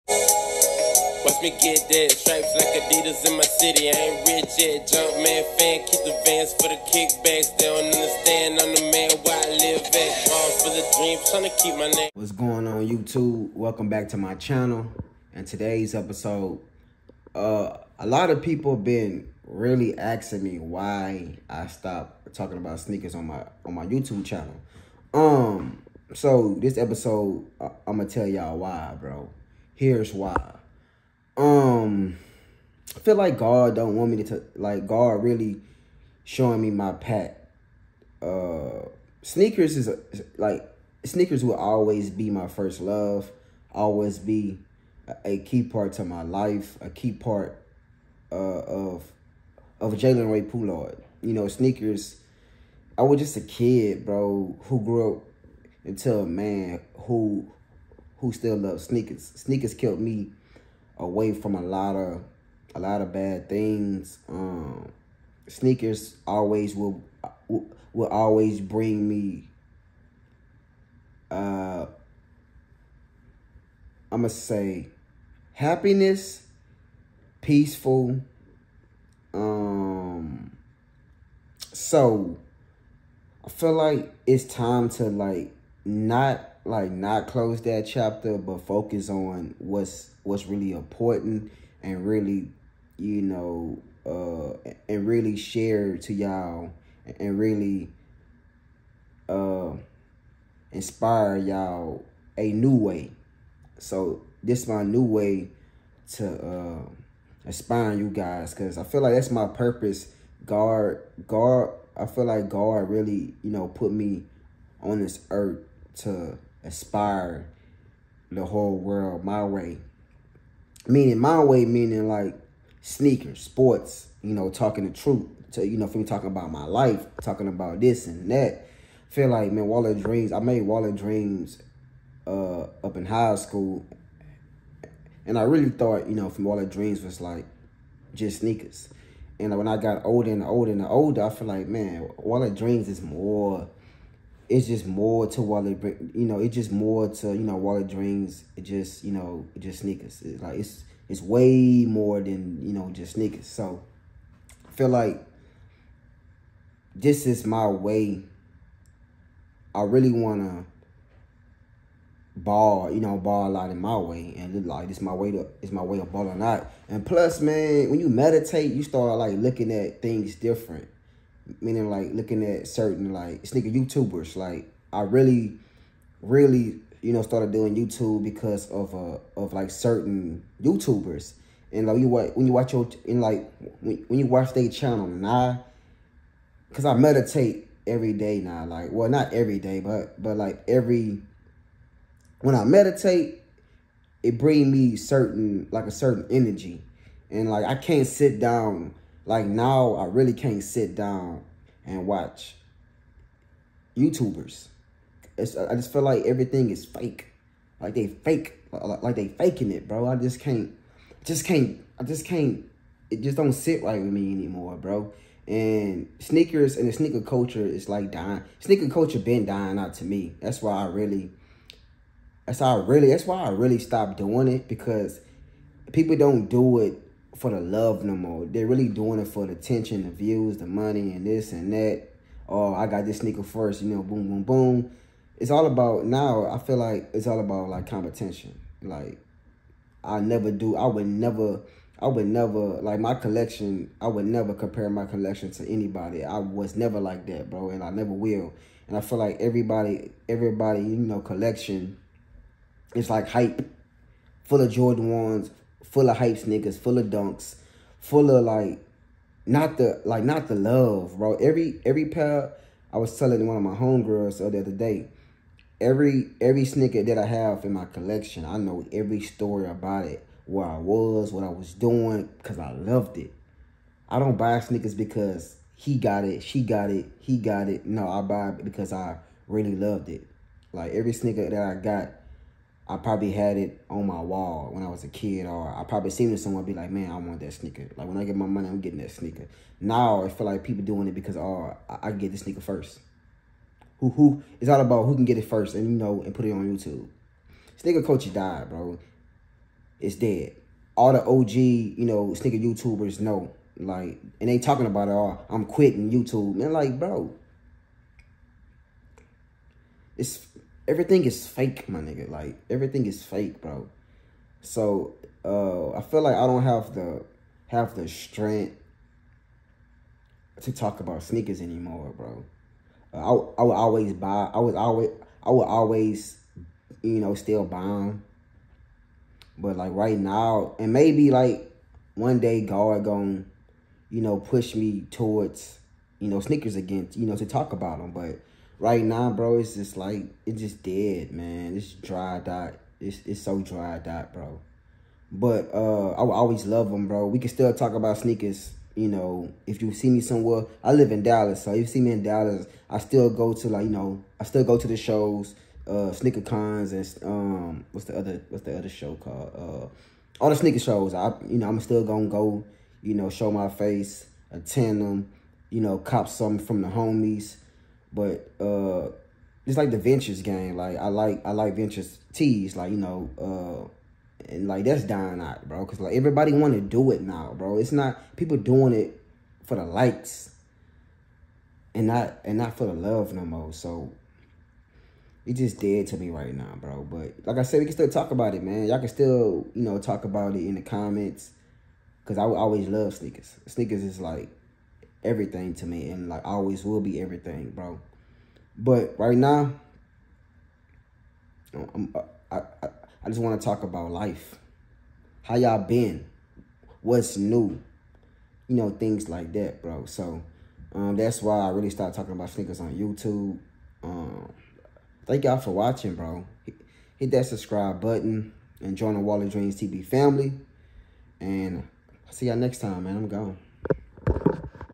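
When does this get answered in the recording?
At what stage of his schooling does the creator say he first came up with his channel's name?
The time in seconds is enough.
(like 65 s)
133 s.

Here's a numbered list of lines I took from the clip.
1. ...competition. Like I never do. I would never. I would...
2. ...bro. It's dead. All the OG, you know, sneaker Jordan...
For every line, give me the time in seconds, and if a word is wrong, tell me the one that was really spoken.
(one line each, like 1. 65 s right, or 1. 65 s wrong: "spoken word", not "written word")
1. 237 s right
2. 298 s wrong: "YouTubers", not "Jordan".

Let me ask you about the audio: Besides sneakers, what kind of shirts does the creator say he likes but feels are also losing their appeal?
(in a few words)
Ventures tees.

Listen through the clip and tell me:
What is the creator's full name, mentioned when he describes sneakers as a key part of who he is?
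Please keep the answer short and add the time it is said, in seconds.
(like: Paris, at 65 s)
Jalen Ray Poulard, at 49 s.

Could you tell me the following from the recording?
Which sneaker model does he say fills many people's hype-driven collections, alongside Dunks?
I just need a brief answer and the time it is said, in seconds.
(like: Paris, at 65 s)
Jordan ones, at 254 s.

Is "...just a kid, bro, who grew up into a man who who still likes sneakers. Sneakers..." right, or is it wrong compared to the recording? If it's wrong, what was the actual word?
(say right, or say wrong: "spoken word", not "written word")
wrong: "loves", not "likes".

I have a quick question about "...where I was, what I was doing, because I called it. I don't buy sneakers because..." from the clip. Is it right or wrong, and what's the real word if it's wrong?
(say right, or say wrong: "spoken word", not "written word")
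wrong: "loved", not "called".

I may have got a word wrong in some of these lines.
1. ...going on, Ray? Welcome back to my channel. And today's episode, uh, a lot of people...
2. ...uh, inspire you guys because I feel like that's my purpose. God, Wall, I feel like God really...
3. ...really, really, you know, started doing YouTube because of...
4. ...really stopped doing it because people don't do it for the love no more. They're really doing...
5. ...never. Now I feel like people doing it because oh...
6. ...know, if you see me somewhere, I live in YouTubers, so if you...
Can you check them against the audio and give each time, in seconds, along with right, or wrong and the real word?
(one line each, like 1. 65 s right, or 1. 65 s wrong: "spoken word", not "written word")
1. 12 s wrong: "YouTube", not "Ray"
2. 106 s wrong: "God", not "Wall"
3. 175 s right
4. 223 s right
5. 289 s wrong: "sneaker", not "never"
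6. 349 s wrong: "Dallas", not "YouTubers".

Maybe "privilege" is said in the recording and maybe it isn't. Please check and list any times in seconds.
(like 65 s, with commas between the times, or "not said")
not said.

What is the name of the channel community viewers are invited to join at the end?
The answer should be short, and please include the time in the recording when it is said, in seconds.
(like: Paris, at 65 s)
Wall of Dreams TV family, at 419 s.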